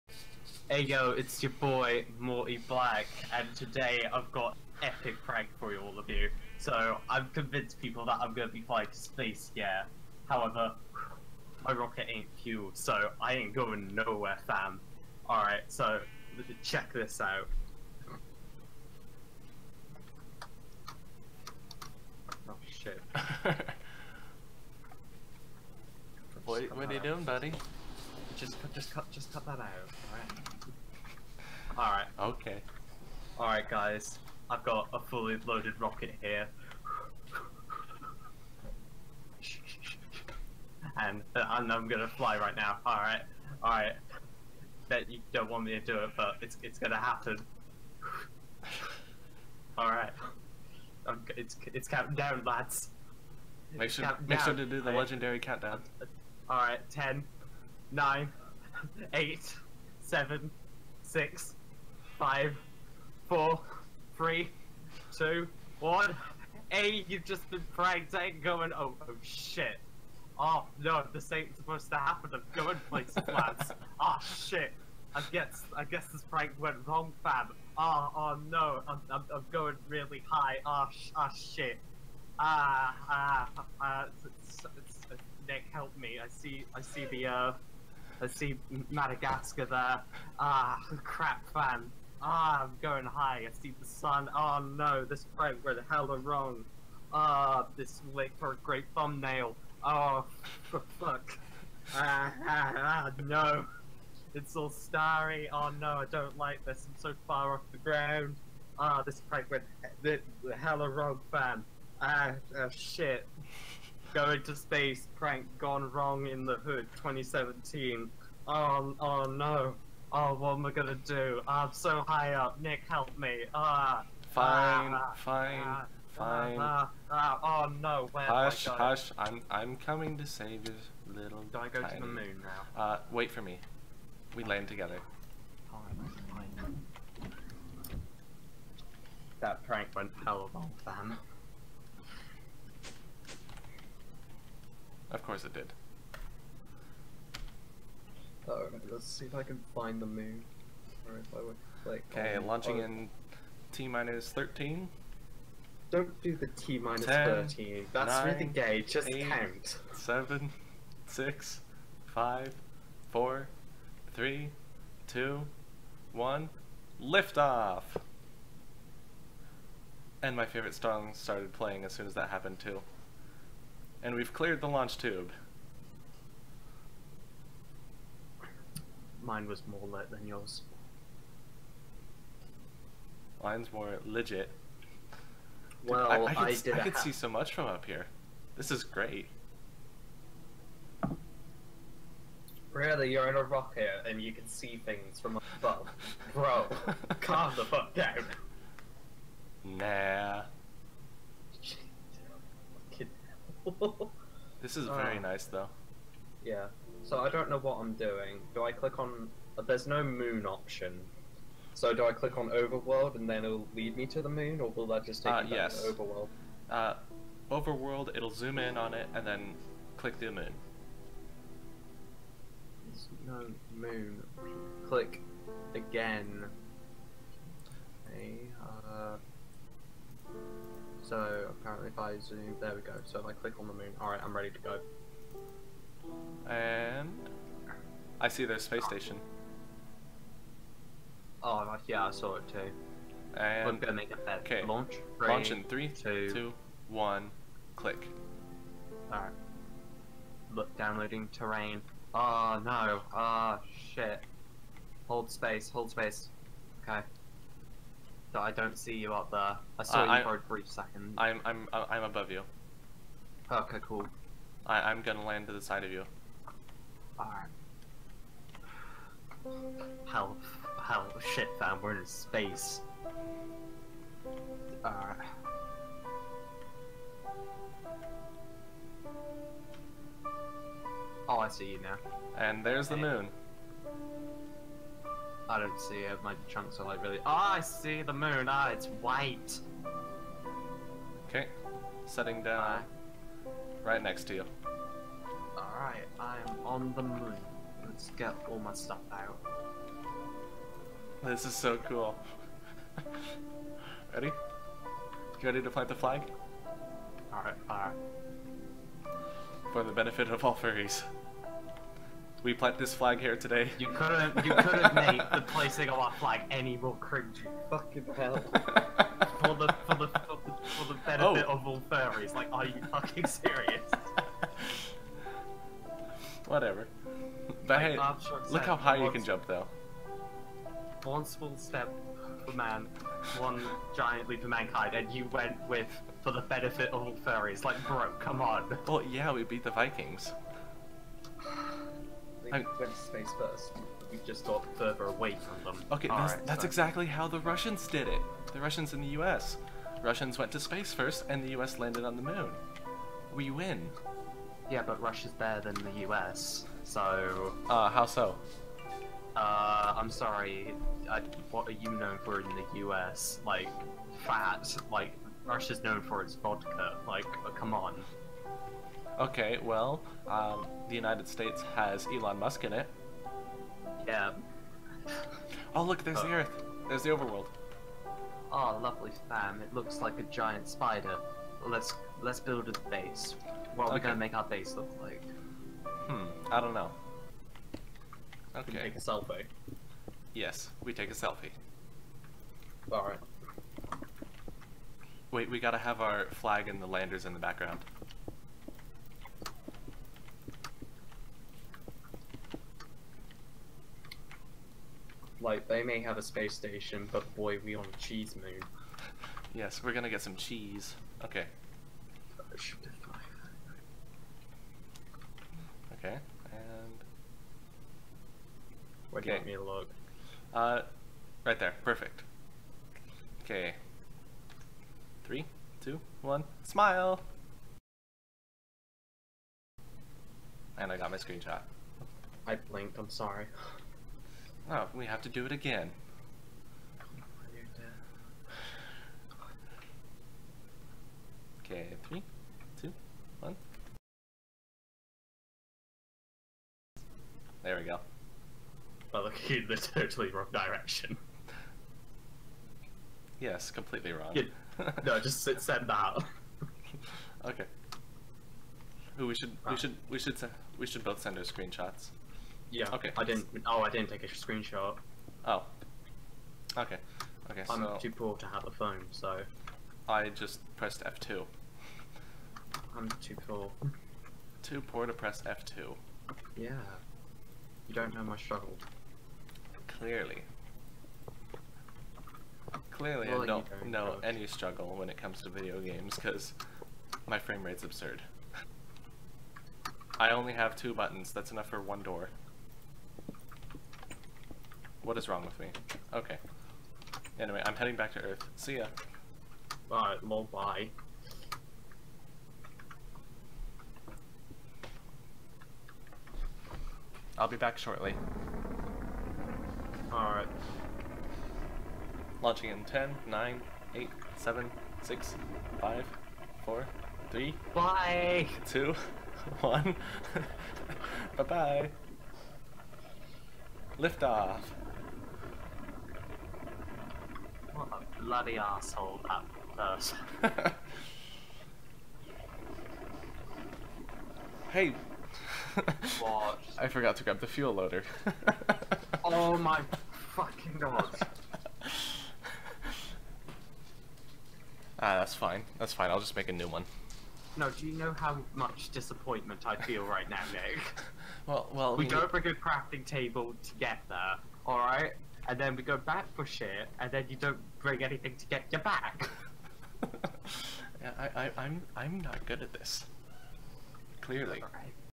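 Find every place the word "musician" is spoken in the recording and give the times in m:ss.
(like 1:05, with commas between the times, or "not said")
not said.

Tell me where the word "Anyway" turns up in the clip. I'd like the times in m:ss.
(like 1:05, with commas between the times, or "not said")
8:17.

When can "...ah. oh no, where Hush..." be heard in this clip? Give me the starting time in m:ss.
2:07.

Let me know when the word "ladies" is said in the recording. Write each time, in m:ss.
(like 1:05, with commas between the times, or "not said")
not said.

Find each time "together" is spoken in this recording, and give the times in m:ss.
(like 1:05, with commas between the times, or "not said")
2:14, 9:13.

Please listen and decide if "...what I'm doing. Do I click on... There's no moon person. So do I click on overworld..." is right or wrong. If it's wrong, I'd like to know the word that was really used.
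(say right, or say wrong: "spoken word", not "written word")
wrong: "option", not "person".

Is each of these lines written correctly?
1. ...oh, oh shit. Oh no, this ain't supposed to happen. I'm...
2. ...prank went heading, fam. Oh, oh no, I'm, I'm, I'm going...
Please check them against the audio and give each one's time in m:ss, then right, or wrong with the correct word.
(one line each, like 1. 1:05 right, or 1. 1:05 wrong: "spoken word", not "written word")
1. 1:08 right
2. 1:16 wrong: "wrong", not "heading".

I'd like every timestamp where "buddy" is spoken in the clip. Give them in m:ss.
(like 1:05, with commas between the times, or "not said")
0:27.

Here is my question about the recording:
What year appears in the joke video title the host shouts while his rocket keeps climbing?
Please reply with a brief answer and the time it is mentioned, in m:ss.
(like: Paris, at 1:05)
2017, at 1:56.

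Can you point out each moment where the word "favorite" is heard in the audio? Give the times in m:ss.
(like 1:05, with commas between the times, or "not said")
2:50.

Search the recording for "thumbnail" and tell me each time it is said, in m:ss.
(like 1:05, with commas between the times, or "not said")
1:38.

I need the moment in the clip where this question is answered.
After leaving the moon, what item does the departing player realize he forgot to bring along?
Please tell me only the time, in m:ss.
8:57.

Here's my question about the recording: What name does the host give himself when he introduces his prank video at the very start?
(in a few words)
Morty Black.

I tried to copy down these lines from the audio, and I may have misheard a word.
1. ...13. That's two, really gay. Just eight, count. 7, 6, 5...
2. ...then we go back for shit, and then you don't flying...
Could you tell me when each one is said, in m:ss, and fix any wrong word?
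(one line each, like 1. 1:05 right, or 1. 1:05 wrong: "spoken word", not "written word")
1. 2:37 wrong: "nine", not "two"
2. 9:15 wrong: "bring", not "flying".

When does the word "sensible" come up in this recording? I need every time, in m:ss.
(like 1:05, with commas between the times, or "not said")
not said.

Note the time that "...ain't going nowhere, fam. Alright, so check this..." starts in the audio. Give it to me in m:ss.
0:13.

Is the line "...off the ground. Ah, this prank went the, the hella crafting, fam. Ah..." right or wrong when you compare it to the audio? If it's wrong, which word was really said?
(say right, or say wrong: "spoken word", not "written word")
wrong: "wrong", not "crafting".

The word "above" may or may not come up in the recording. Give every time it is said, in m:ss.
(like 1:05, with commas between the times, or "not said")
3:15, 4:22.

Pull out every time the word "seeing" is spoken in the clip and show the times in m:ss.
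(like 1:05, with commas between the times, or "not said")
not said.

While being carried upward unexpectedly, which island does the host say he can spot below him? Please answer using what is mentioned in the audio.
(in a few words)
Madagascar.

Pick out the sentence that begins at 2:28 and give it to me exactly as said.
Let's see if I can find the moon.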